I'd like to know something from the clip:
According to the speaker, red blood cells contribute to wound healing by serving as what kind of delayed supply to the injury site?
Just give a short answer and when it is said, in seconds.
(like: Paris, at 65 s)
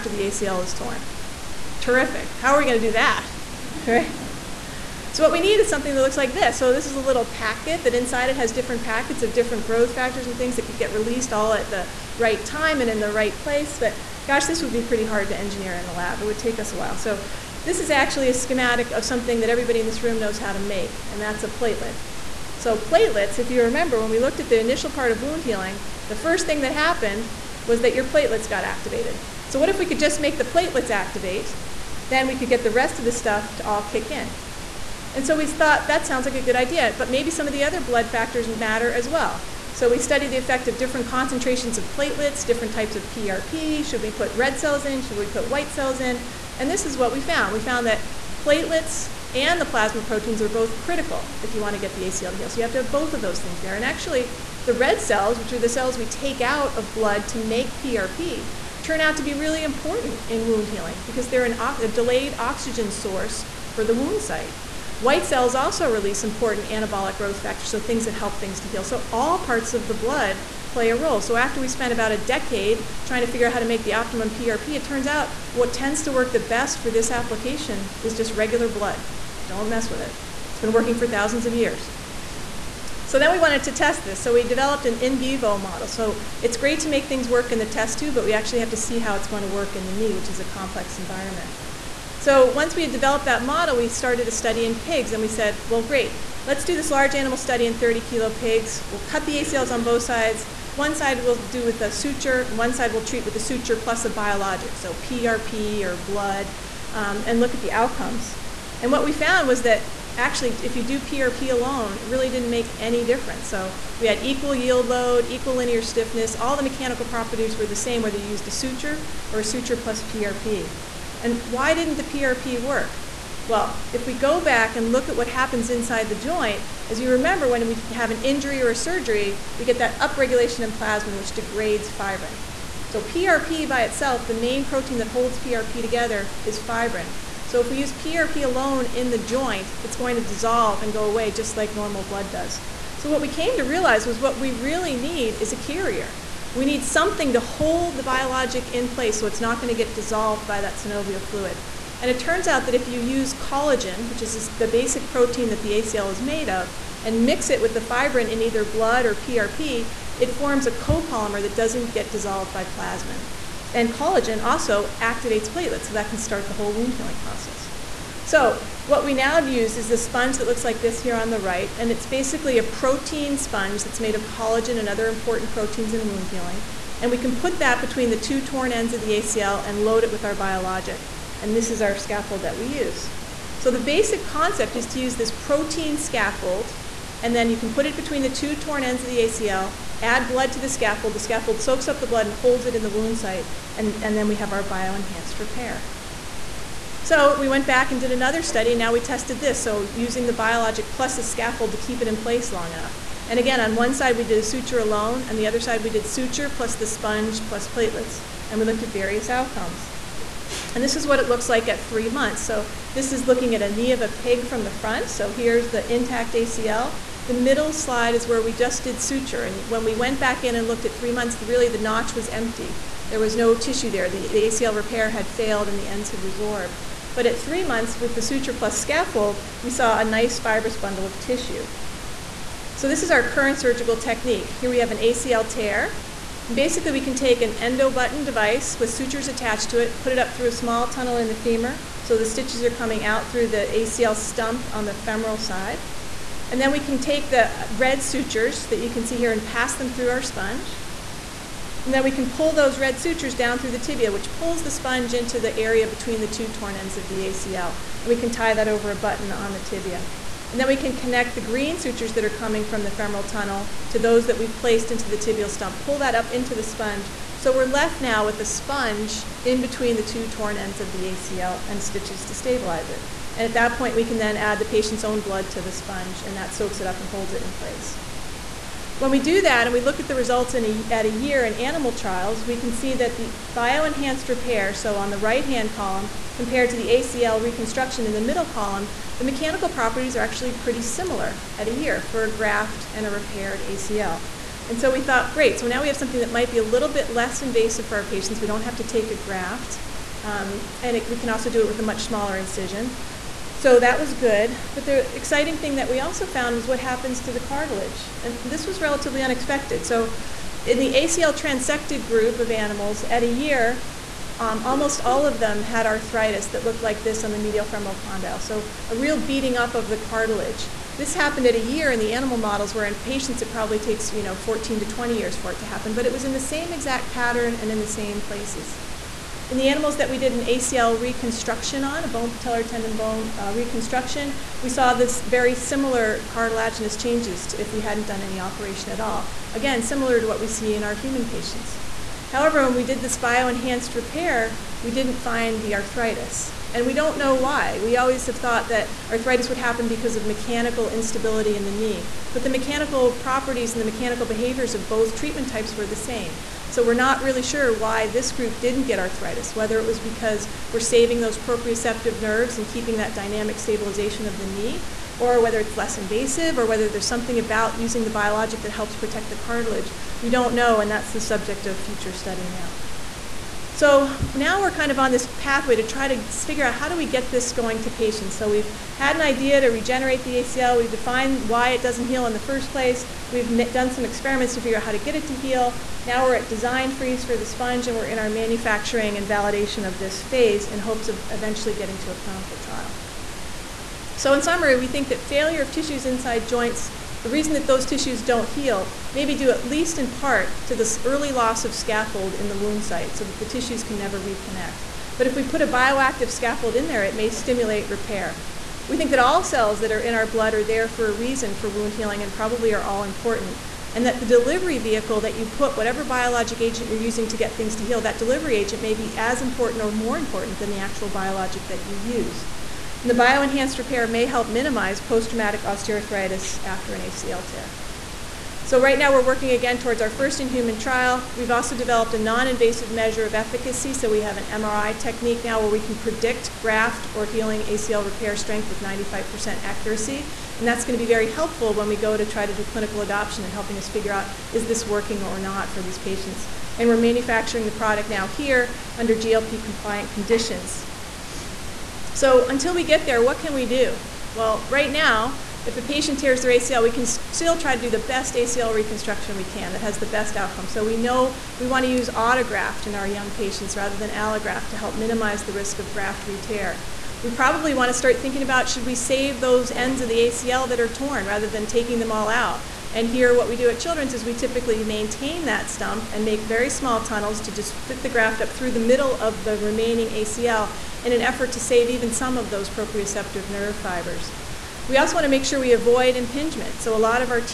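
oxygen source, at 62 s.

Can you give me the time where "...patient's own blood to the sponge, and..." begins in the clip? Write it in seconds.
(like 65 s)
274 s.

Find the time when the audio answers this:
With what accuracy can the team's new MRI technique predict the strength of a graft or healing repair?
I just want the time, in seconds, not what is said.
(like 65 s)
438 s.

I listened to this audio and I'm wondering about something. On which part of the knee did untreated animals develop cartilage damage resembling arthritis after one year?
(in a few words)
medial femoral condyle.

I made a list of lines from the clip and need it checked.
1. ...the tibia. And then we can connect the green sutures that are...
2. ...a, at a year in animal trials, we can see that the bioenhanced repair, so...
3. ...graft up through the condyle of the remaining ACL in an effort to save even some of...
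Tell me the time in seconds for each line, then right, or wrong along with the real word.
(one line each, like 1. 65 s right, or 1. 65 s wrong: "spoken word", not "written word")
1. 259 s right
2. 280 s right
3. 478 s wrong: "middle", not "condyle".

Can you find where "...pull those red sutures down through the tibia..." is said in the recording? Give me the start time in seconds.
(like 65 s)
252 s.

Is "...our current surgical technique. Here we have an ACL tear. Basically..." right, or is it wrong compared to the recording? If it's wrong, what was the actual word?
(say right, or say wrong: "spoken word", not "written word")
right.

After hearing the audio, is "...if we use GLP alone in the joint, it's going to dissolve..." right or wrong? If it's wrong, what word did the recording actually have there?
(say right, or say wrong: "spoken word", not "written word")
wrong: "PRP", not "GLP".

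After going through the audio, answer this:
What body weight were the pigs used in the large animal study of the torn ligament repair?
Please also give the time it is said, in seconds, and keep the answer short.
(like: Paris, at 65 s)
30 kilos, at 97 s.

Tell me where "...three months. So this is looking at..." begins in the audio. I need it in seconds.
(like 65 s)
211 s.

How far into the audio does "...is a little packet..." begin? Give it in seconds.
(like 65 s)
6 s.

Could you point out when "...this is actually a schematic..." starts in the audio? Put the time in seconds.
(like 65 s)
17 s.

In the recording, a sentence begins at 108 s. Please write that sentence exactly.
And what we found was that actually, if you do PRP alone, it really didn't make any difference.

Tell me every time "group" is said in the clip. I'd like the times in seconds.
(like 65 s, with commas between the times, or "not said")
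312 s, 358 s.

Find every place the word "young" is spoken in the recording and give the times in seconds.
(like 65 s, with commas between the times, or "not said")
463 s.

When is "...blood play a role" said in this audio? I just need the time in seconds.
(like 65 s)
69 s.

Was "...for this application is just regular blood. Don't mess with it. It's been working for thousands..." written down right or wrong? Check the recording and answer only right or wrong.
right.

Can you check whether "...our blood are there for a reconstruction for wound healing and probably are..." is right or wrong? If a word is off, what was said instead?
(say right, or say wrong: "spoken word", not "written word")
wrong: "reason", not "reconstruction".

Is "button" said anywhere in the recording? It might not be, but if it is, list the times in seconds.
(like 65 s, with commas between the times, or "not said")
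237 s, 258 s.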